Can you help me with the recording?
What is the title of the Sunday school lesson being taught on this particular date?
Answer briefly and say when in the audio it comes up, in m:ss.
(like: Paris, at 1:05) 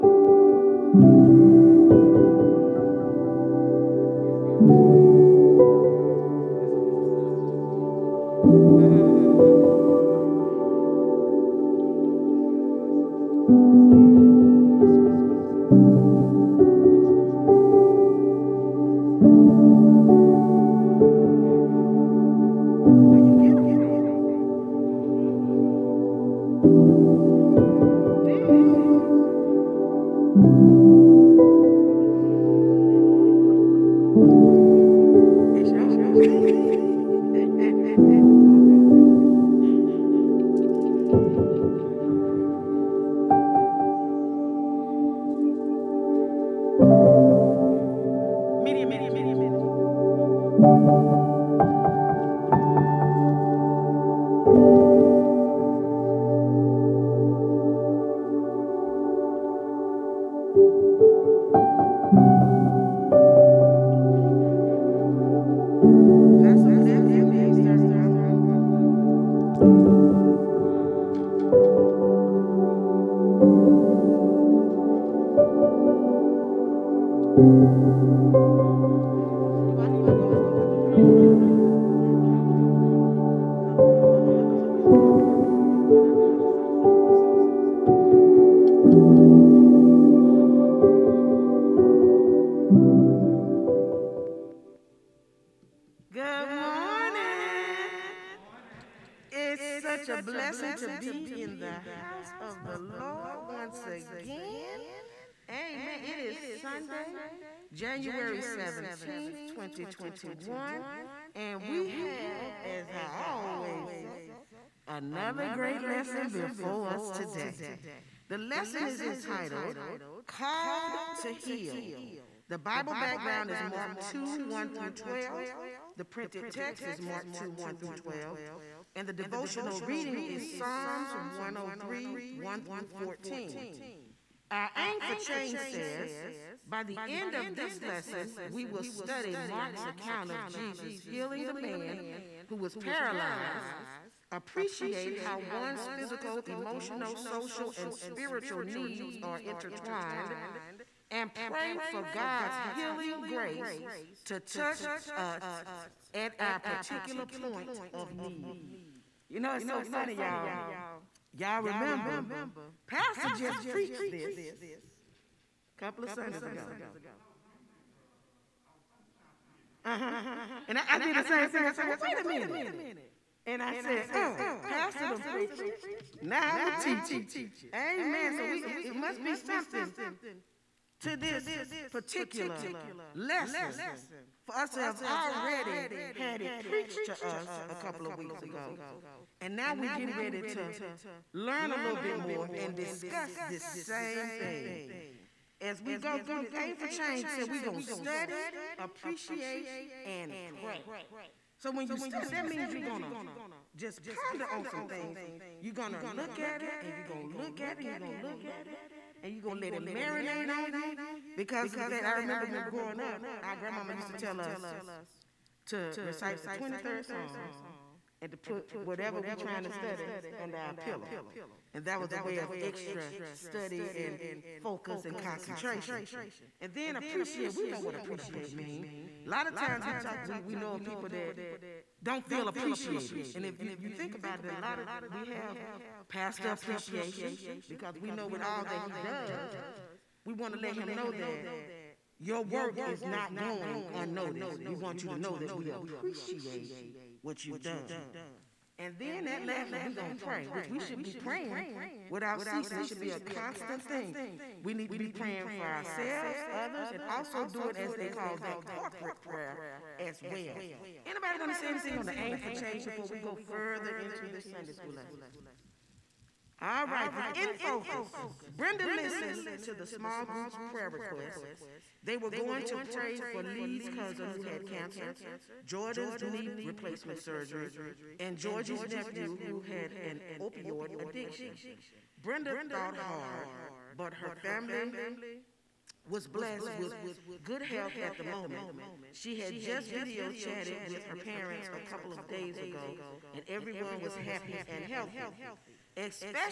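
Called to Heal, at 2:00.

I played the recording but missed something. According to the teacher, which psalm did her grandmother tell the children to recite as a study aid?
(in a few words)
23rd Psalm.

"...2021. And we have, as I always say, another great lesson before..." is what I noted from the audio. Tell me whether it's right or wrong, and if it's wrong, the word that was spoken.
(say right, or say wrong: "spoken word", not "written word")
right.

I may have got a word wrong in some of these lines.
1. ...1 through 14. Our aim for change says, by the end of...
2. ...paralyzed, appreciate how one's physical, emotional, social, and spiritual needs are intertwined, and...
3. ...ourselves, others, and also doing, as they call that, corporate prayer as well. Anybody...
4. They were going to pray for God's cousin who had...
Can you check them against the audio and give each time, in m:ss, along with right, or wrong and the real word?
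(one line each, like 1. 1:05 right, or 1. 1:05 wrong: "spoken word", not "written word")
1. 2:12 right
2. 2:22 right
3. 4:15 right
4. 4:32 wrong: "Lee", not "God".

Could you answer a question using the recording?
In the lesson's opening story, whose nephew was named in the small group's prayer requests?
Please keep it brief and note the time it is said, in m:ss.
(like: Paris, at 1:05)
Georgie's, at 4:38.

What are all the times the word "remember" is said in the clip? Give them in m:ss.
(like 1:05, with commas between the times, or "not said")
2:41, 3:32.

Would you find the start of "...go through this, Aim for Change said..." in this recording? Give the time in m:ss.
3:15.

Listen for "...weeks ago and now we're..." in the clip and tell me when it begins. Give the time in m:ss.
3:08.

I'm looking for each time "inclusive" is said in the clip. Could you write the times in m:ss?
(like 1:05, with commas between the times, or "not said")
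not said.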